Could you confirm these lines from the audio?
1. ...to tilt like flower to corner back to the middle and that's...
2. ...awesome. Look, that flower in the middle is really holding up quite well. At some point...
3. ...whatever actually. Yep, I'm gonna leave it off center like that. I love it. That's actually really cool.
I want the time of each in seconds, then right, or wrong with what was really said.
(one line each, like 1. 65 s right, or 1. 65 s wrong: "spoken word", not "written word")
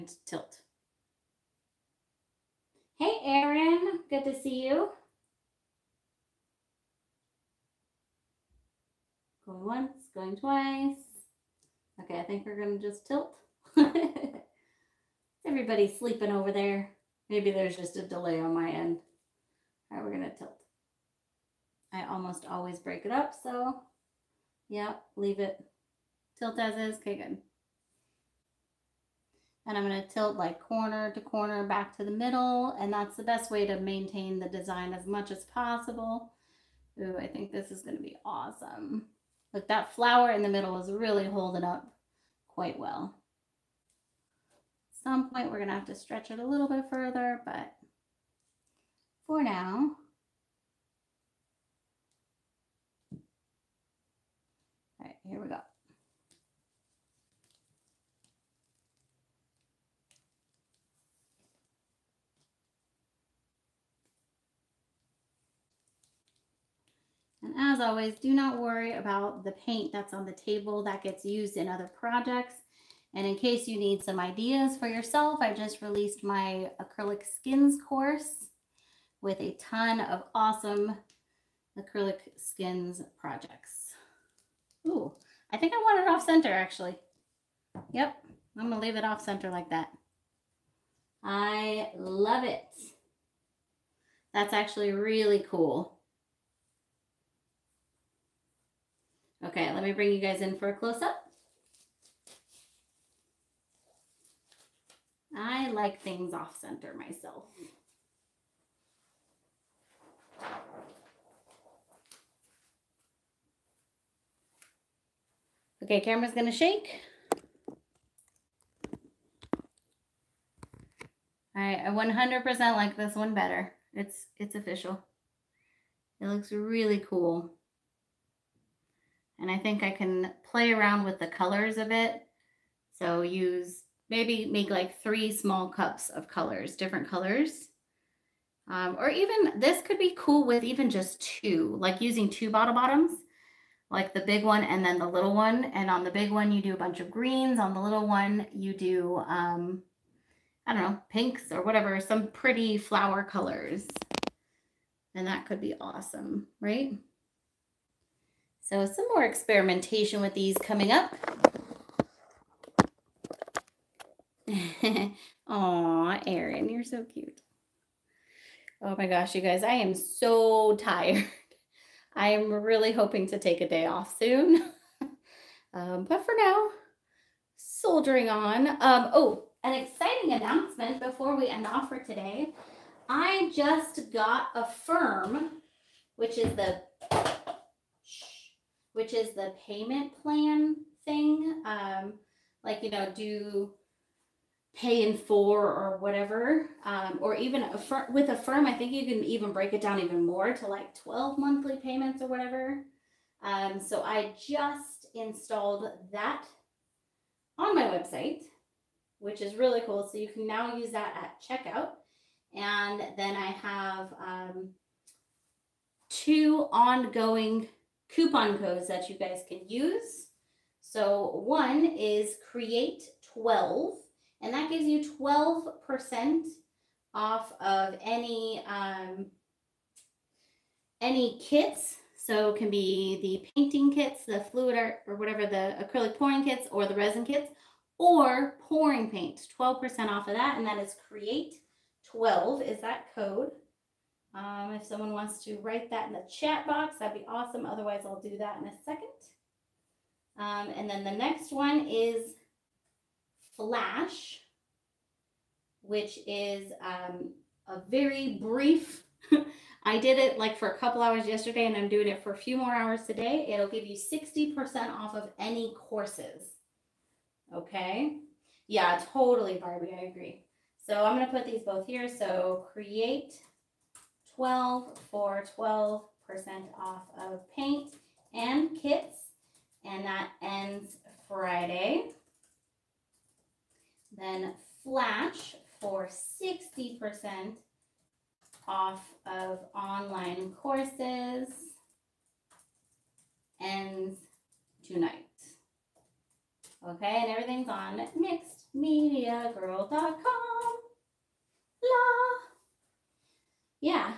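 1. 30 s wrong: "corner", not "flower"
2. 38 s right
3. 86 s wrong: "center", not "whatever".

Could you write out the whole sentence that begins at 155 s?
And that could be awesome, right?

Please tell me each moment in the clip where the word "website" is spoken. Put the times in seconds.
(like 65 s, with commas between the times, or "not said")
207 s.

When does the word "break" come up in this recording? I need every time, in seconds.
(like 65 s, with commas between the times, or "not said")
22 s, 199 s.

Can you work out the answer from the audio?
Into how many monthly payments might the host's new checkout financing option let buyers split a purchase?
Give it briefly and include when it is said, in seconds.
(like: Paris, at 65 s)
12, at 201 s.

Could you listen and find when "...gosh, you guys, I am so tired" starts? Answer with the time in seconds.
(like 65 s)
169 s.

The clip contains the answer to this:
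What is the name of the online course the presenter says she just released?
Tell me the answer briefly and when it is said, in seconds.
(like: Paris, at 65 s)
acrylic skins course, at 76 s.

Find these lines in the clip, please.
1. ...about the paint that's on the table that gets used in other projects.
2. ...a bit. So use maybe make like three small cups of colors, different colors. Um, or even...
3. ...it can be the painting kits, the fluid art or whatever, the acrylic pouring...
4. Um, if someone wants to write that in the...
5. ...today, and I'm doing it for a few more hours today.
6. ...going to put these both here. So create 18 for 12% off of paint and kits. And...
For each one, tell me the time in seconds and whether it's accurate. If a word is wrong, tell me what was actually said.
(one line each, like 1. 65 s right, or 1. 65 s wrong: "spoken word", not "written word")
1. 68 s right
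2. 131 s right
3. 232 s right
4. 244 s right
5. 261 s wrong: "yesterday", not "today"
6. 271 s wrong: "12", not "18".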